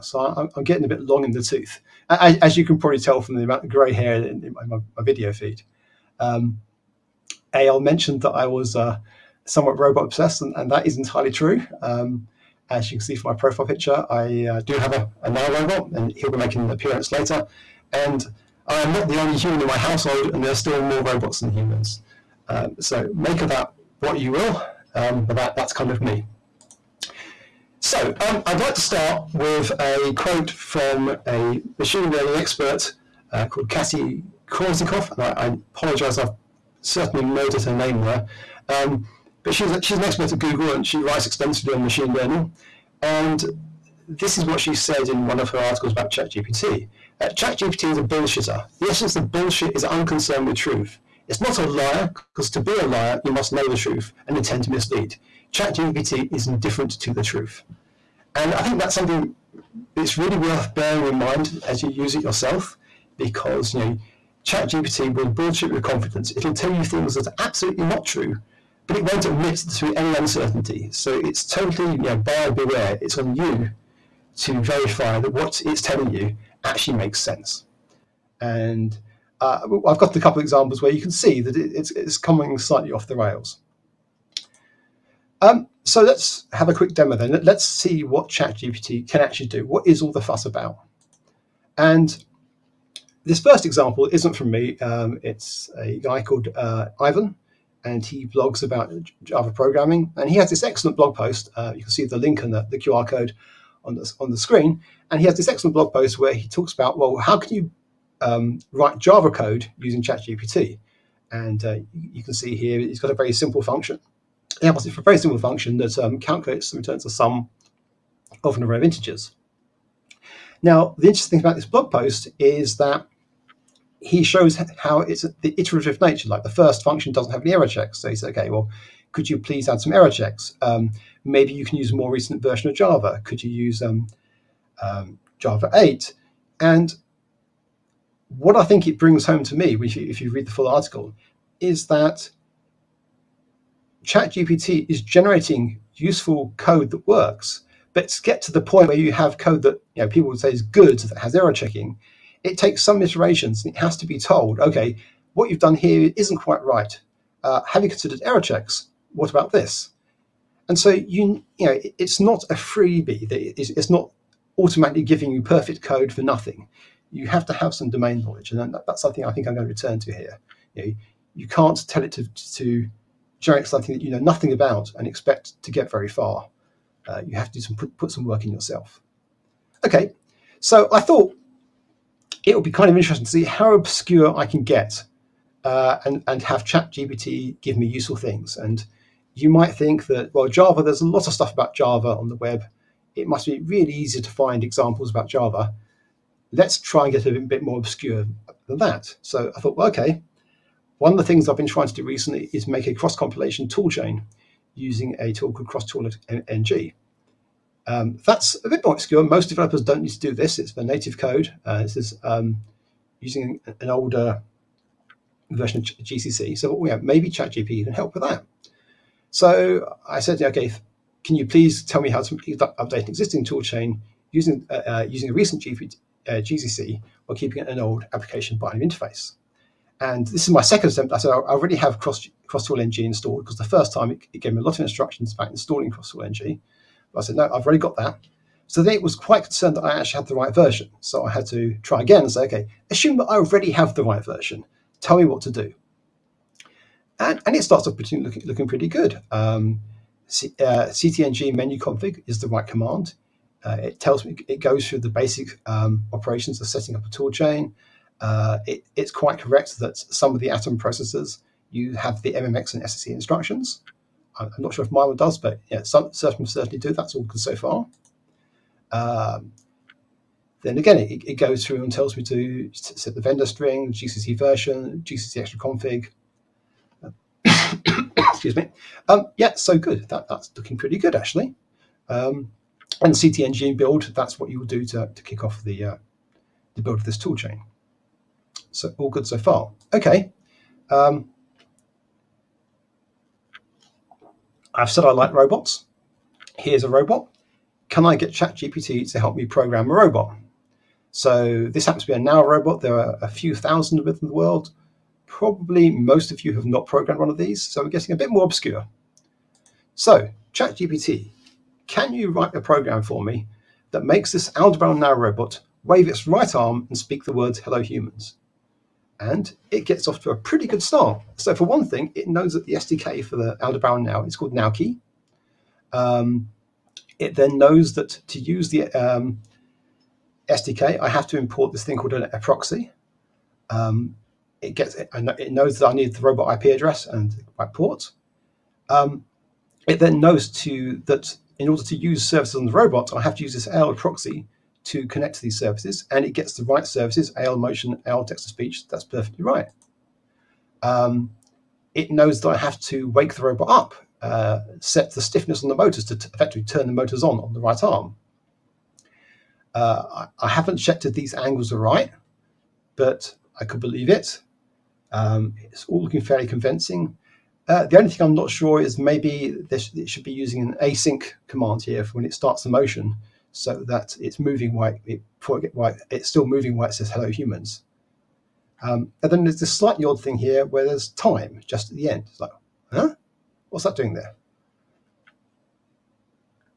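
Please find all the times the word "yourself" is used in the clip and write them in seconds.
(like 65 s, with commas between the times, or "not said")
62 s, 178 s.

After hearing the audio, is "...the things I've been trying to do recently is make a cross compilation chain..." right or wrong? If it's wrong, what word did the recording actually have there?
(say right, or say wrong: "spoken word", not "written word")
wrong: "toolchain", not "chain".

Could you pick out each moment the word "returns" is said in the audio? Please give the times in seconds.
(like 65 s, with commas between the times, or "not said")
116 s, 169 s.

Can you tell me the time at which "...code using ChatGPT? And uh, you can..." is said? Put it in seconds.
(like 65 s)
109 s.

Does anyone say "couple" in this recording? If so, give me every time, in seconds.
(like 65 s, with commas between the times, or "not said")
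80 s.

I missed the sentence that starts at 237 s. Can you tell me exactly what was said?
But I said, no, I've already got that.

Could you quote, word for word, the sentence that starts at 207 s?
Um, that's a bit more obscure.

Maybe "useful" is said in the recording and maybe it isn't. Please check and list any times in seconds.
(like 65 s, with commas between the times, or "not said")
145 s, 187 s.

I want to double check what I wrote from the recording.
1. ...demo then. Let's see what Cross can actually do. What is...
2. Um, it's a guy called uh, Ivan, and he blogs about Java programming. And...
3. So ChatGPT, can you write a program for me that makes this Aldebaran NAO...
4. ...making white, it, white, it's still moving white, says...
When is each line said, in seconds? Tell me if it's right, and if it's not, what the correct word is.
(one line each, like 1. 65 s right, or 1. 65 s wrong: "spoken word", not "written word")
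1. 86 s wrong: "ChatGPT", not "Cross"
2. 94 s right
3. 309 s right
4. 374 s wrong: "moving", not "making".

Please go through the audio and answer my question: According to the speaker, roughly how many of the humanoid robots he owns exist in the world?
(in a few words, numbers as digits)
A few thousand.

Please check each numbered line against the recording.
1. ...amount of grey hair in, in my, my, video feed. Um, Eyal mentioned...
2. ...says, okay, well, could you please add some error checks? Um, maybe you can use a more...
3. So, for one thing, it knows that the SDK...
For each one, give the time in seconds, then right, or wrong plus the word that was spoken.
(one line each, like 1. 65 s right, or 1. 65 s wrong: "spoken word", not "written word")
1. 3 s right
2. 128 s right
3. 321 s right.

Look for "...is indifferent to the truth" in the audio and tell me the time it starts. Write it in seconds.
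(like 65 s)
56 s.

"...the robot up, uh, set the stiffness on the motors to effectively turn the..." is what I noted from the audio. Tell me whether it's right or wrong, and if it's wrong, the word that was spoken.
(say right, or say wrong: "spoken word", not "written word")
right.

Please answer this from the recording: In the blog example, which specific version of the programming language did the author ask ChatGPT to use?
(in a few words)
Java 8.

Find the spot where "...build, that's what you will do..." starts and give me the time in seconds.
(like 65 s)
283 s.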